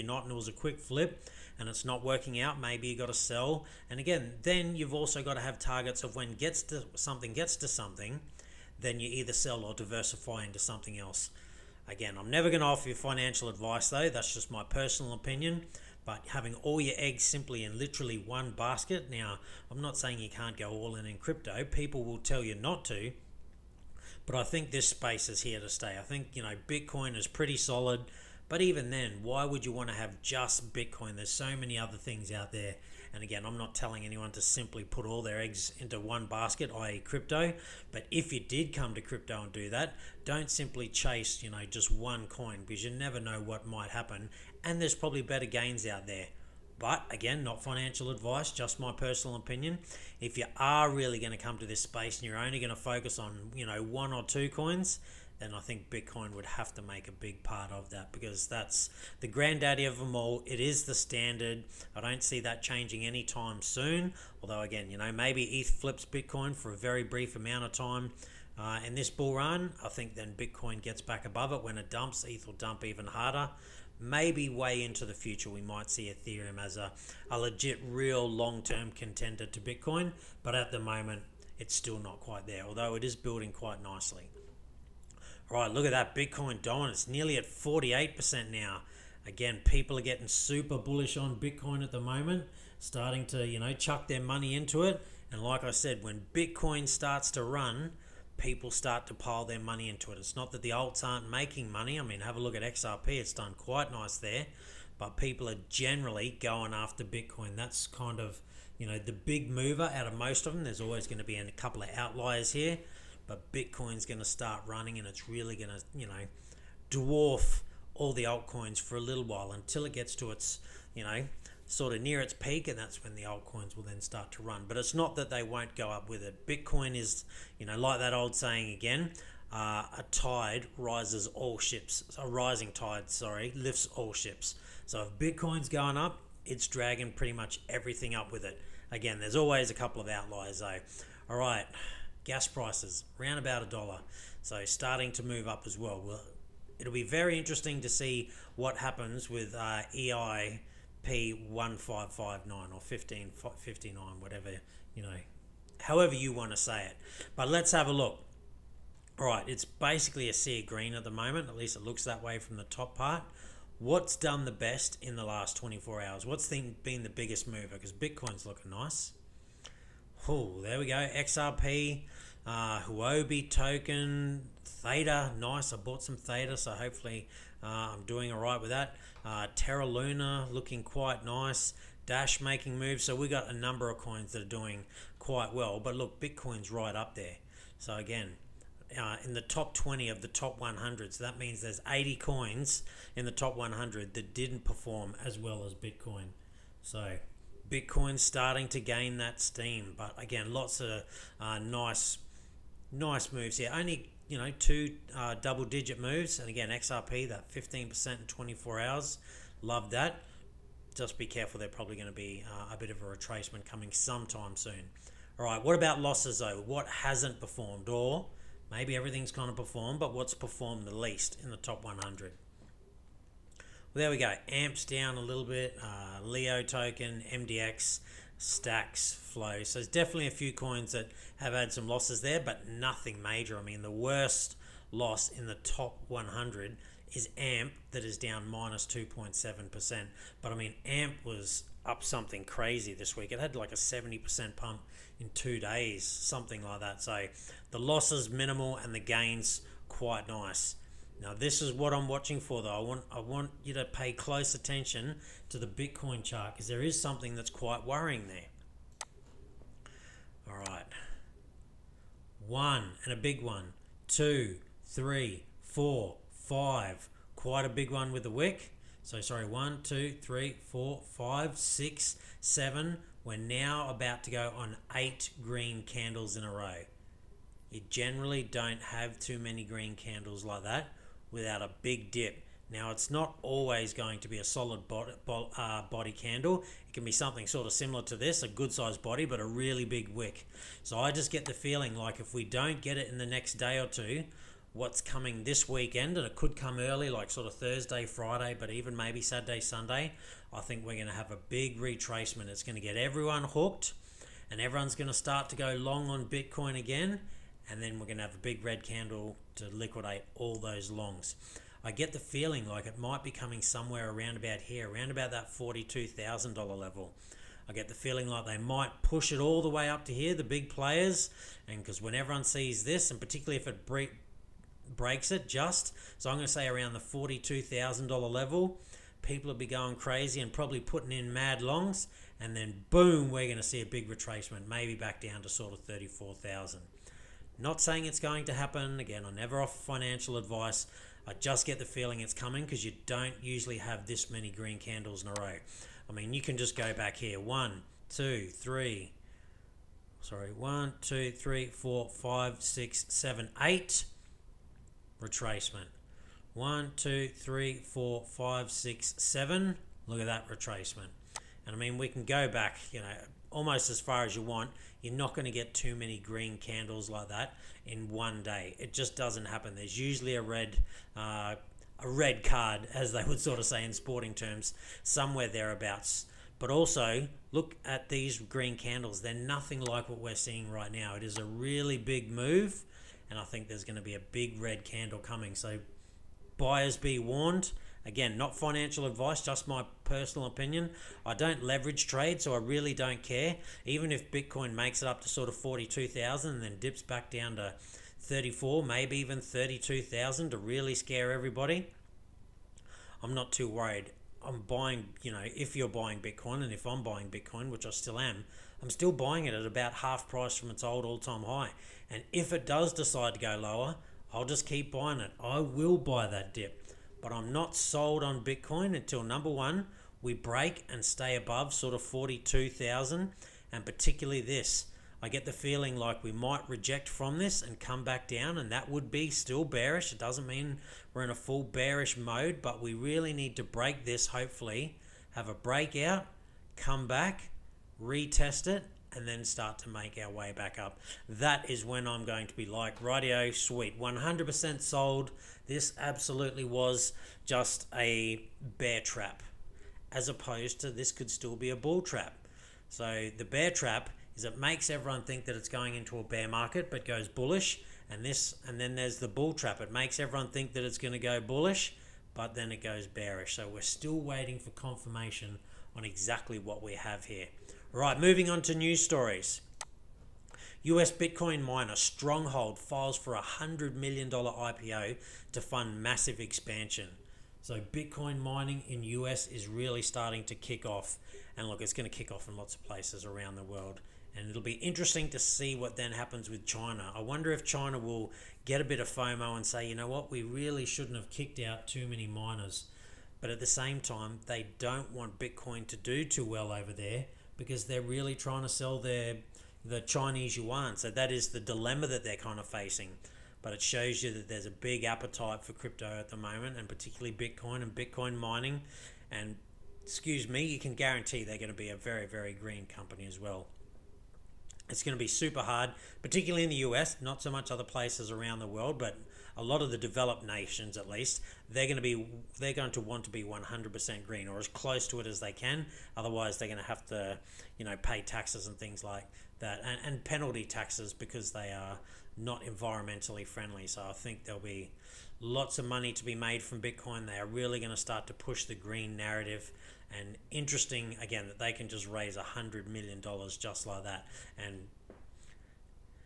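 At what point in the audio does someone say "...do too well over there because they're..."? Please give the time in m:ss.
8:15.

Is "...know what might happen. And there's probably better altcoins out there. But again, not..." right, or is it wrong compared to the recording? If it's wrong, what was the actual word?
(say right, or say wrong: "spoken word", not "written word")
wrong: "gains", not "altcoins".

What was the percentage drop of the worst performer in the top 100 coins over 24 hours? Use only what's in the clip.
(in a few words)
-2.7%.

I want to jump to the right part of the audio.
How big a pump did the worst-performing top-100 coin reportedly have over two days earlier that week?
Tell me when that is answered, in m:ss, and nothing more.
4:03.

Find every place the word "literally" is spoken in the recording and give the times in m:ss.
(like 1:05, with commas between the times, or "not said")
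0:17.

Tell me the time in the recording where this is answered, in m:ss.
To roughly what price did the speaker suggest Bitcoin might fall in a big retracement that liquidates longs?
5:35.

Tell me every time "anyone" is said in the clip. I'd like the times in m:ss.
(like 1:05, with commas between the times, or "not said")
0:34.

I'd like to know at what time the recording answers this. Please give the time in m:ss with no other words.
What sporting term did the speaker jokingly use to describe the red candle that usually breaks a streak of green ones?
6:11.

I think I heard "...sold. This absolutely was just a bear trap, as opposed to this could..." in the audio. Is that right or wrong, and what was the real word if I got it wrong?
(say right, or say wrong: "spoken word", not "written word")
right.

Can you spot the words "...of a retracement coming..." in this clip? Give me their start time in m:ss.
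3:32.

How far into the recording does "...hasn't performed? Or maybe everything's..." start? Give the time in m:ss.
3:36.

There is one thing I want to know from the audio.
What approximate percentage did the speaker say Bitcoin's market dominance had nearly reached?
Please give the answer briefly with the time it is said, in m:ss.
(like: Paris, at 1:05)
48%, at 1:27.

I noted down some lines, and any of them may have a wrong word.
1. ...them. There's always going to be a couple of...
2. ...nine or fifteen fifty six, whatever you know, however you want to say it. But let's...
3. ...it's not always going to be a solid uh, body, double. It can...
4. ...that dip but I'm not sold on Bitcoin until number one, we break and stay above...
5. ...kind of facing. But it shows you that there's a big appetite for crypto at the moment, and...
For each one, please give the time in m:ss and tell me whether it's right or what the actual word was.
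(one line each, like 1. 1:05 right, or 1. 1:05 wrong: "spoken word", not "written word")
1. 1:50 right
2. 2:32 wrong: "nine", not "six"
3. 4:42 wrong: "candle", not "double"
4. 6:56 right
5. 8:22 right.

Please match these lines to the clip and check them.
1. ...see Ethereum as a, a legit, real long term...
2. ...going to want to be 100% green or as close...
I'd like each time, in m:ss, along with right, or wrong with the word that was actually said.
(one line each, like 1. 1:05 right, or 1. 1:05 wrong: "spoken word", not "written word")
1. 1:15 right
2. 8:42 right.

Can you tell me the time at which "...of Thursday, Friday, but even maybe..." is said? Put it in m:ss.
4:57.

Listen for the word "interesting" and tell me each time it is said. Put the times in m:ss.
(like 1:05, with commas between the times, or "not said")
2:27, 8:04, 9:00.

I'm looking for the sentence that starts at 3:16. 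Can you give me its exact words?
So Bitcoin's starting to gain that steam.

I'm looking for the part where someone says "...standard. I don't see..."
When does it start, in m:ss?
1:00.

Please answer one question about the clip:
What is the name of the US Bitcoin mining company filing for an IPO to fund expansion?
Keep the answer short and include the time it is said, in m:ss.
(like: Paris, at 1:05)
Stronghold, at 7:51.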